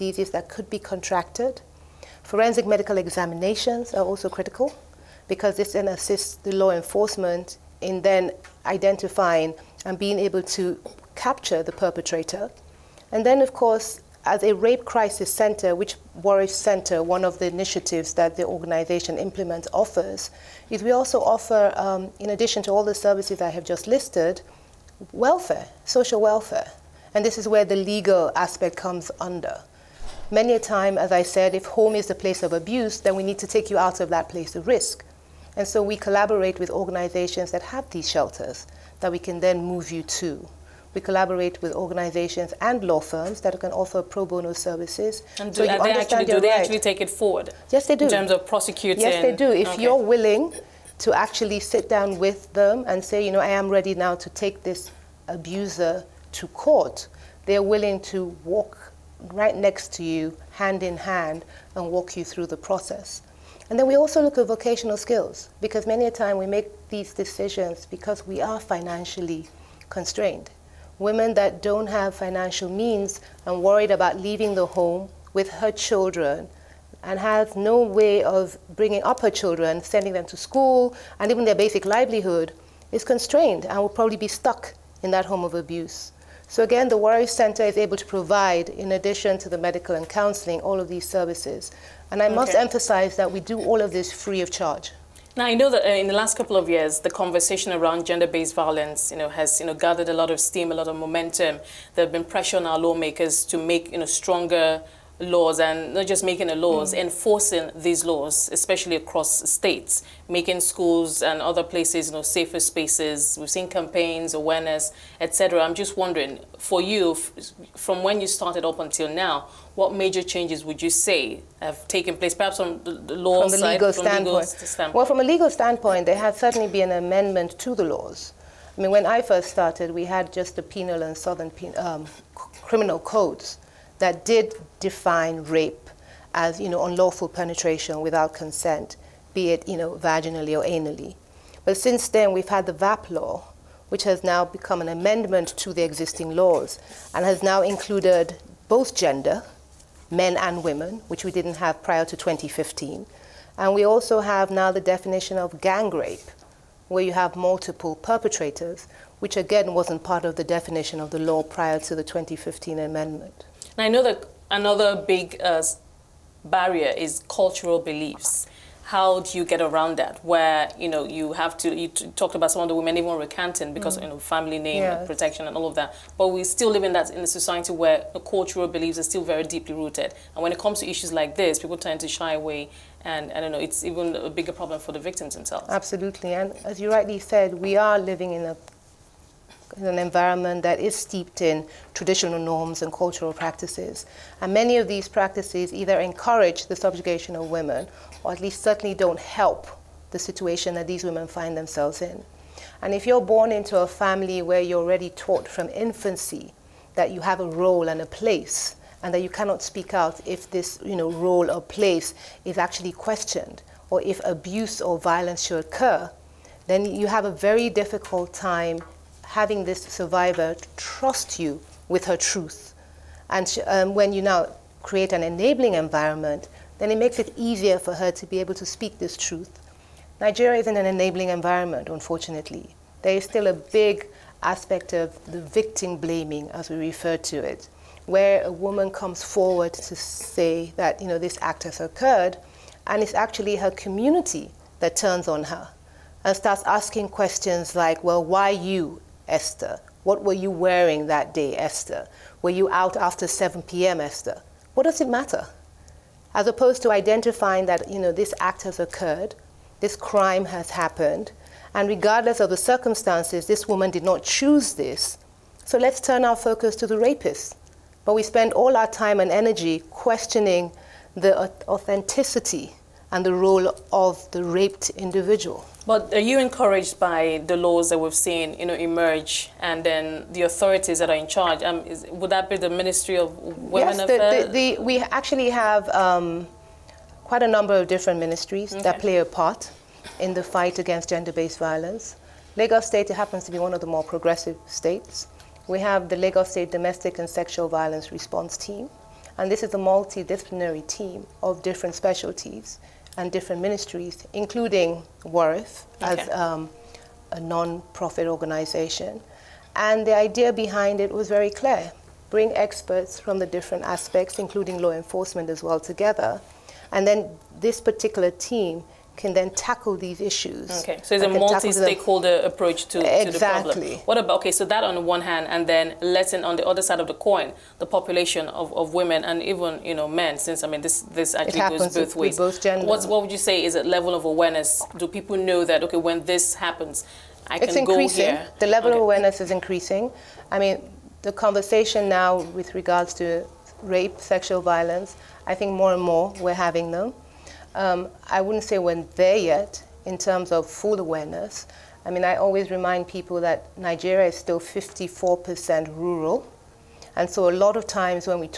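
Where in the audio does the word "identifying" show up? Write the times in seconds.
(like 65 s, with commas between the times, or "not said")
8 s, 256 s.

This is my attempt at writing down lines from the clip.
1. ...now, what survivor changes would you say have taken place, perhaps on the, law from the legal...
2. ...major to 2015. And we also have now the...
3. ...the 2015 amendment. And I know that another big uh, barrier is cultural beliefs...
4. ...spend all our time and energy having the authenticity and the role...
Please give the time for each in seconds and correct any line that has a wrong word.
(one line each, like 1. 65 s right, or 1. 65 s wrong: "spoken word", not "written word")
1. 119 s wrong: "major", not "survivor"
2. 151 s wrong: "prior", not "major"
3. 161 s right
4. 268 s wrong: "questioning", not "having".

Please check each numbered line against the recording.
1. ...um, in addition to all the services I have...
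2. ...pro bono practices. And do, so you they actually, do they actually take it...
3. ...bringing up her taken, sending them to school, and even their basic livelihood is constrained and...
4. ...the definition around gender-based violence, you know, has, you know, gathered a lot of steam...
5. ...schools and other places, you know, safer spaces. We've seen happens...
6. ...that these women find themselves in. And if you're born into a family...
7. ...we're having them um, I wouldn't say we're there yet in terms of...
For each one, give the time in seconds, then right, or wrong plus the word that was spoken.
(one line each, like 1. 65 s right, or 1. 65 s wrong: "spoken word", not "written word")
1. 21 s right
2. 44 s wrong: "services", not "practices"
3. 78 s wrong: "children", not "taken"
4. 96 s wrong: "conversation", not "definition"
5. 110 s wrong: "campaigns", not "happens"
6. 200 s right
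7. 346 s right.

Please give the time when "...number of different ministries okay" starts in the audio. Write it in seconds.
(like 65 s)
287 s.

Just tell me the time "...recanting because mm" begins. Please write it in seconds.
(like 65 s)
173 s.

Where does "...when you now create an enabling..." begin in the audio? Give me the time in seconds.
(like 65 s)
223 s.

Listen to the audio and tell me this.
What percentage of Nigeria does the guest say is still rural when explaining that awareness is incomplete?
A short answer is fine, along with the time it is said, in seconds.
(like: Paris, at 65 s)
54%, at 354 s.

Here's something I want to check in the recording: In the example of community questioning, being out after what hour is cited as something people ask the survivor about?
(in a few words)
7 p.m.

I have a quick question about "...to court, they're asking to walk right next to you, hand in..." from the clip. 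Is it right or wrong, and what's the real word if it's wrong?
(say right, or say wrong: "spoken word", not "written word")
wrong: "willing", not "asking".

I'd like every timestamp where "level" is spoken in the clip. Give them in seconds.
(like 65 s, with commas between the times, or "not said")
333 s, 338 s.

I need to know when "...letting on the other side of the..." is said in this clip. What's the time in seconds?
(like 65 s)
326 s.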